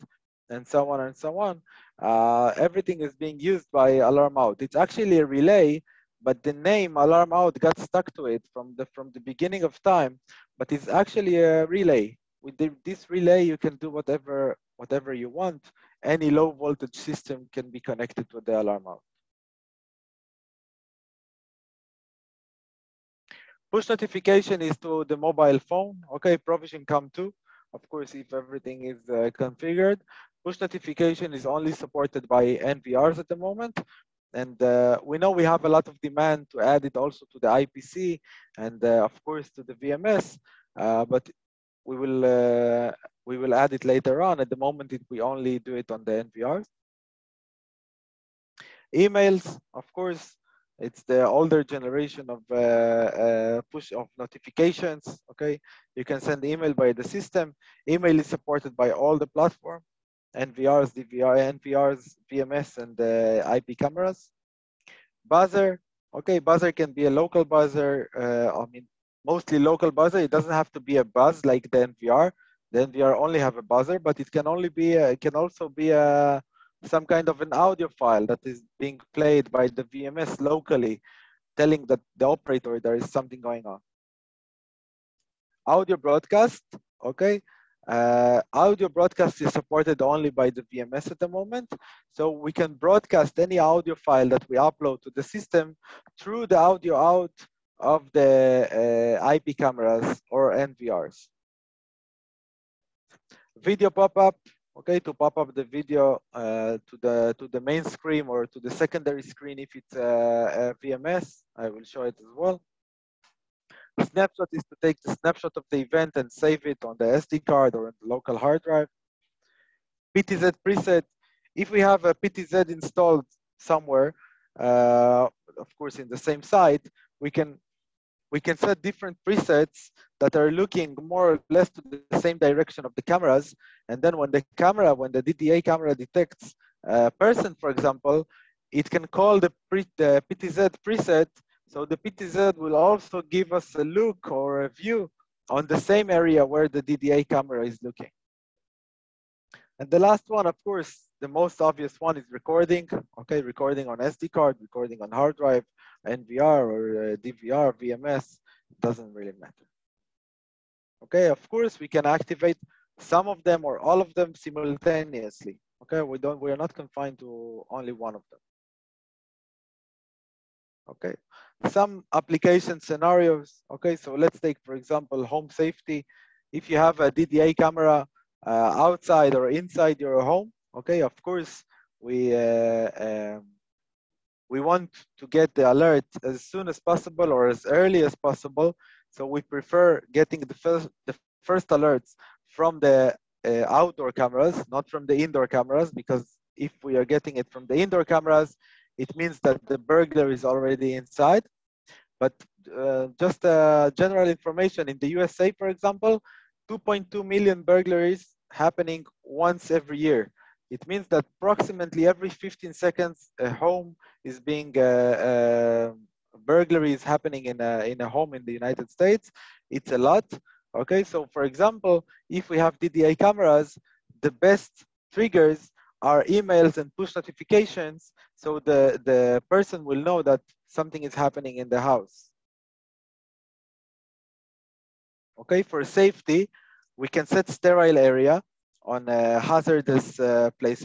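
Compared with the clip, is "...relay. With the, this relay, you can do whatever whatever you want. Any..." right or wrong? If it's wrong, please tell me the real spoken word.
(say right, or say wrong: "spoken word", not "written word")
right.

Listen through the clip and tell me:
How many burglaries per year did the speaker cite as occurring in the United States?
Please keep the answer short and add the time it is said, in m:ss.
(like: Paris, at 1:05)
2.2 million, at 3:26.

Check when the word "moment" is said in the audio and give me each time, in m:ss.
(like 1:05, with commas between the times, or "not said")
0:33, 0:44, 1:31.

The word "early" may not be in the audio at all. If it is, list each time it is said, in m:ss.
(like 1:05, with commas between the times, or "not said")
3:07.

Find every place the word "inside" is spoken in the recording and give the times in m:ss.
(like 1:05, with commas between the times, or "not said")
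2:59, 3:21.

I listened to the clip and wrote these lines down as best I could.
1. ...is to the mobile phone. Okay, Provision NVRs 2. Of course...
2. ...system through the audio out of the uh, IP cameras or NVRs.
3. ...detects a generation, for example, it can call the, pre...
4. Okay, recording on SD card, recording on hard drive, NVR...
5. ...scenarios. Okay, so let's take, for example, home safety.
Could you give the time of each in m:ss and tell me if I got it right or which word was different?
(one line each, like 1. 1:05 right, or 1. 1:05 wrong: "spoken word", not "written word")
1. 0:24 wrong: "Cam", not "NVRs"
2. 1:35 right
3. 2:15 wrong: "person", not "generation"
4. 2:33 right
5. 2:52 right.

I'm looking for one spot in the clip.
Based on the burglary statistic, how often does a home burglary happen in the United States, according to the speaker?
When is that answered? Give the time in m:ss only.
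3:32.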